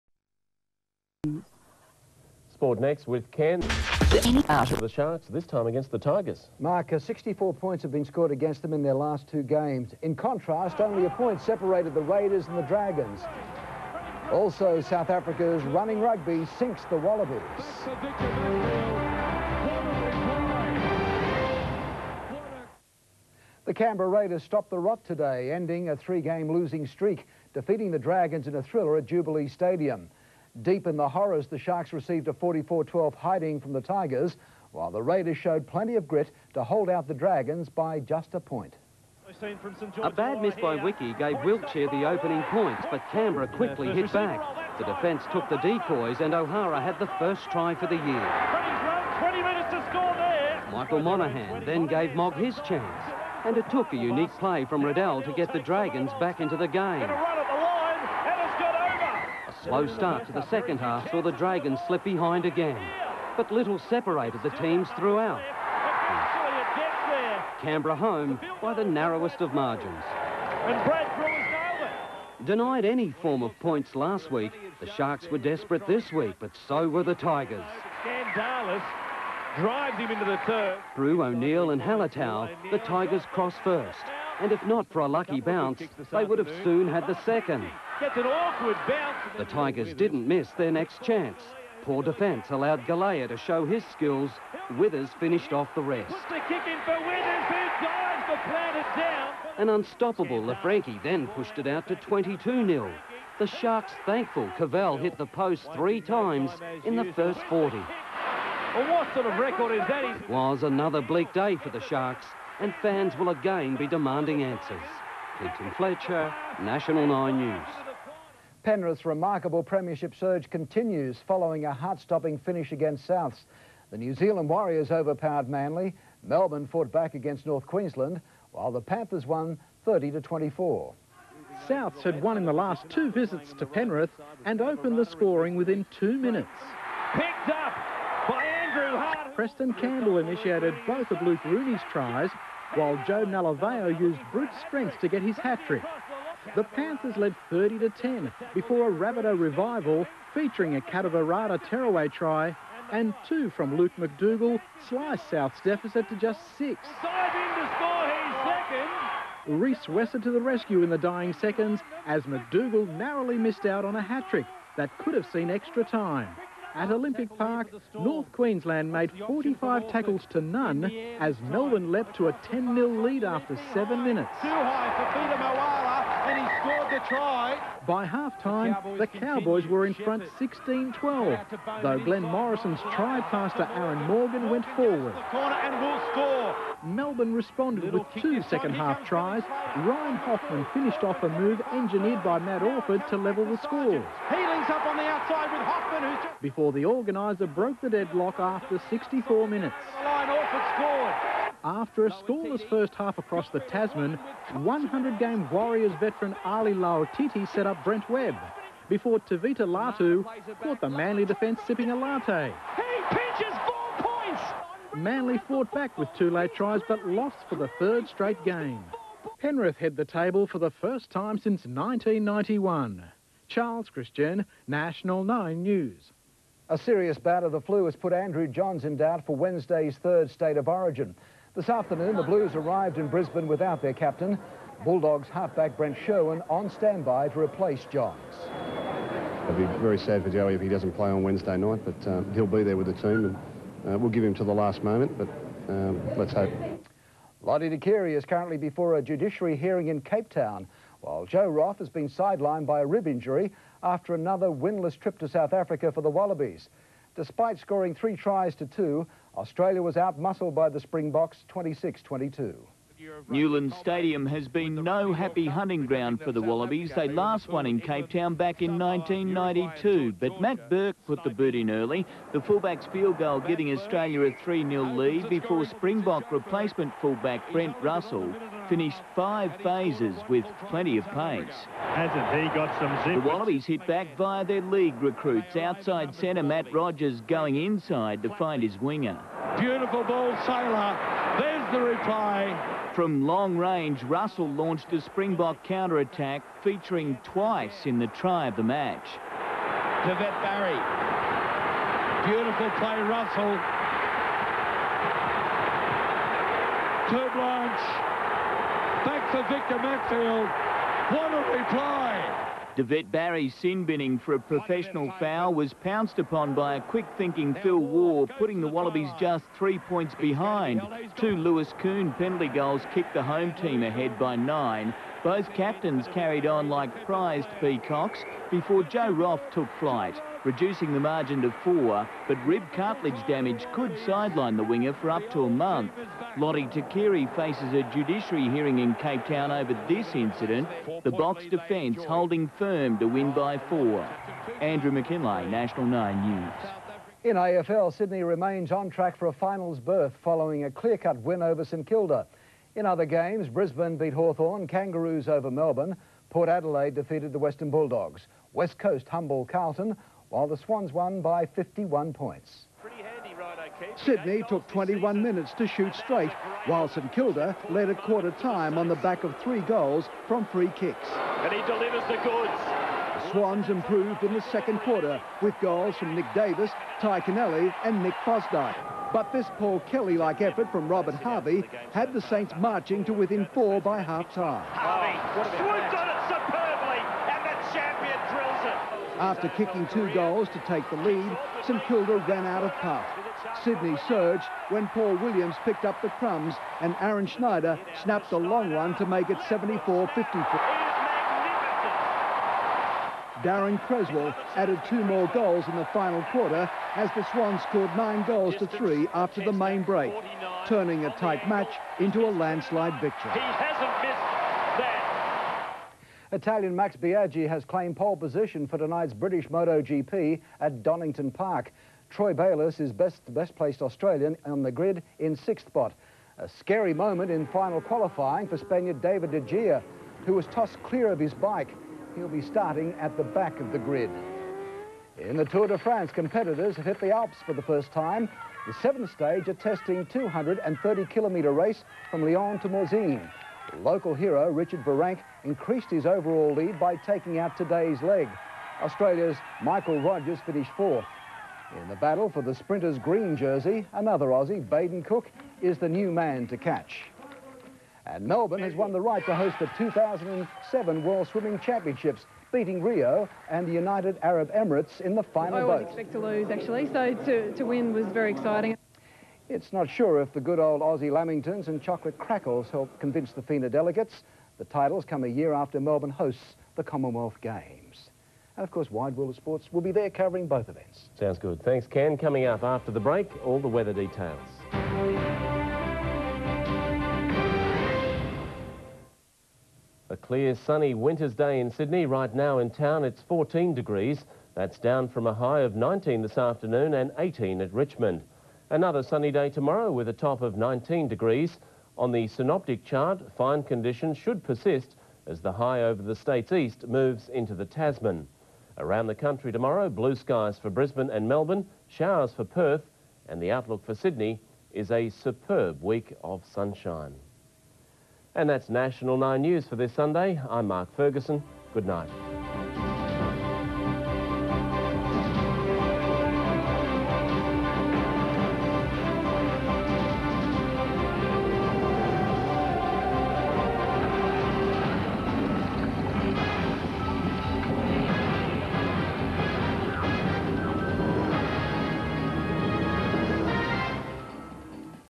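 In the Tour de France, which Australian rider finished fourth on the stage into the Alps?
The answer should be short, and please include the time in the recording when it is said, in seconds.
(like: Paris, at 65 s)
Michael Rogers, at 449 s.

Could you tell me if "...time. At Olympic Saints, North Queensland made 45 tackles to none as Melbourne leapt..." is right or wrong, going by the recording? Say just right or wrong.
wrong.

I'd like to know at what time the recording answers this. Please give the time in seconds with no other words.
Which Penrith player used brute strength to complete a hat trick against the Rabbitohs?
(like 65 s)
143 s.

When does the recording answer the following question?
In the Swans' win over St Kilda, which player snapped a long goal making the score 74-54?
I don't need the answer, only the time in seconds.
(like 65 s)
397 s.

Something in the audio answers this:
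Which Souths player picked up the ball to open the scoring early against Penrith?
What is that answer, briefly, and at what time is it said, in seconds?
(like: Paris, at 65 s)
Andrew Hart, at 138 s.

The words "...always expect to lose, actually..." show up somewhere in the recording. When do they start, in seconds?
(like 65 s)
465 s.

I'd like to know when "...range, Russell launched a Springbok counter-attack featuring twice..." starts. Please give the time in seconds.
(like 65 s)
293 s.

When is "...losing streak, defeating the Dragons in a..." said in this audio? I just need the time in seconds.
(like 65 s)
26 s.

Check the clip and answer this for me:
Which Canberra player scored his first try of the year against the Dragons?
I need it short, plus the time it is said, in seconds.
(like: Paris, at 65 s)
O'Hara, at 46 s.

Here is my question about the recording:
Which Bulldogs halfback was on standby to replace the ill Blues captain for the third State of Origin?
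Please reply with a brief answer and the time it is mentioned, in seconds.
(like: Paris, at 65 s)
Brent Sherwin, at 235 s.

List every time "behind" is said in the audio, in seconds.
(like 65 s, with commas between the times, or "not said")
62 s, 320 s.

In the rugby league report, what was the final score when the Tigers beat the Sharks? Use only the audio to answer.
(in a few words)
44-12.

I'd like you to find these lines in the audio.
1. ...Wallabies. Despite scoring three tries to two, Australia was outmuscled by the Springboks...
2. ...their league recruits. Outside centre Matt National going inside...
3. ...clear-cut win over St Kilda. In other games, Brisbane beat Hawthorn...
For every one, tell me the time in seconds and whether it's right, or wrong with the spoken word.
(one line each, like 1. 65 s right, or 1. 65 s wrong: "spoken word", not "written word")
1. 256 s right
2. 284 s wrong: "Rogers", not "National"
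3. 350 s right.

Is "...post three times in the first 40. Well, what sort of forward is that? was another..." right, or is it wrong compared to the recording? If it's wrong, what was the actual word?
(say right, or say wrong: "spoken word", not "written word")
wrong: "record", not "forward".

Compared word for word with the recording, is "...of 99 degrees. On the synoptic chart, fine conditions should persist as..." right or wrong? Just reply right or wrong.
wrong.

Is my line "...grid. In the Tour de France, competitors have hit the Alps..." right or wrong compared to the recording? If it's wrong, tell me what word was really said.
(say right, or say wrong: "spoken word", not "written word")
right.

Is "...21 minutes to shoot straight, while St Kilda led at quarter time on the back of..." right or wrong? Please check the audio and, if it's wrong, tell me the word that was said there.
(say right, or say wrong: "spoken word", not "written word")
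right.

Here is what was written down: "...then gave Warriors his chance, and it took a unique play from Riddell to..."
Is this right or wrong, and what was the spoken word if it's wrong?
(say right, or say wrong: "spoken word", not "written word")
wrong: "Mogg", not "Warriors".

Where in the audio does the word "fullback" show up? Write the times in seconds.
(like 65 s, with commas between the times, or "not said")
272 s, 277 s.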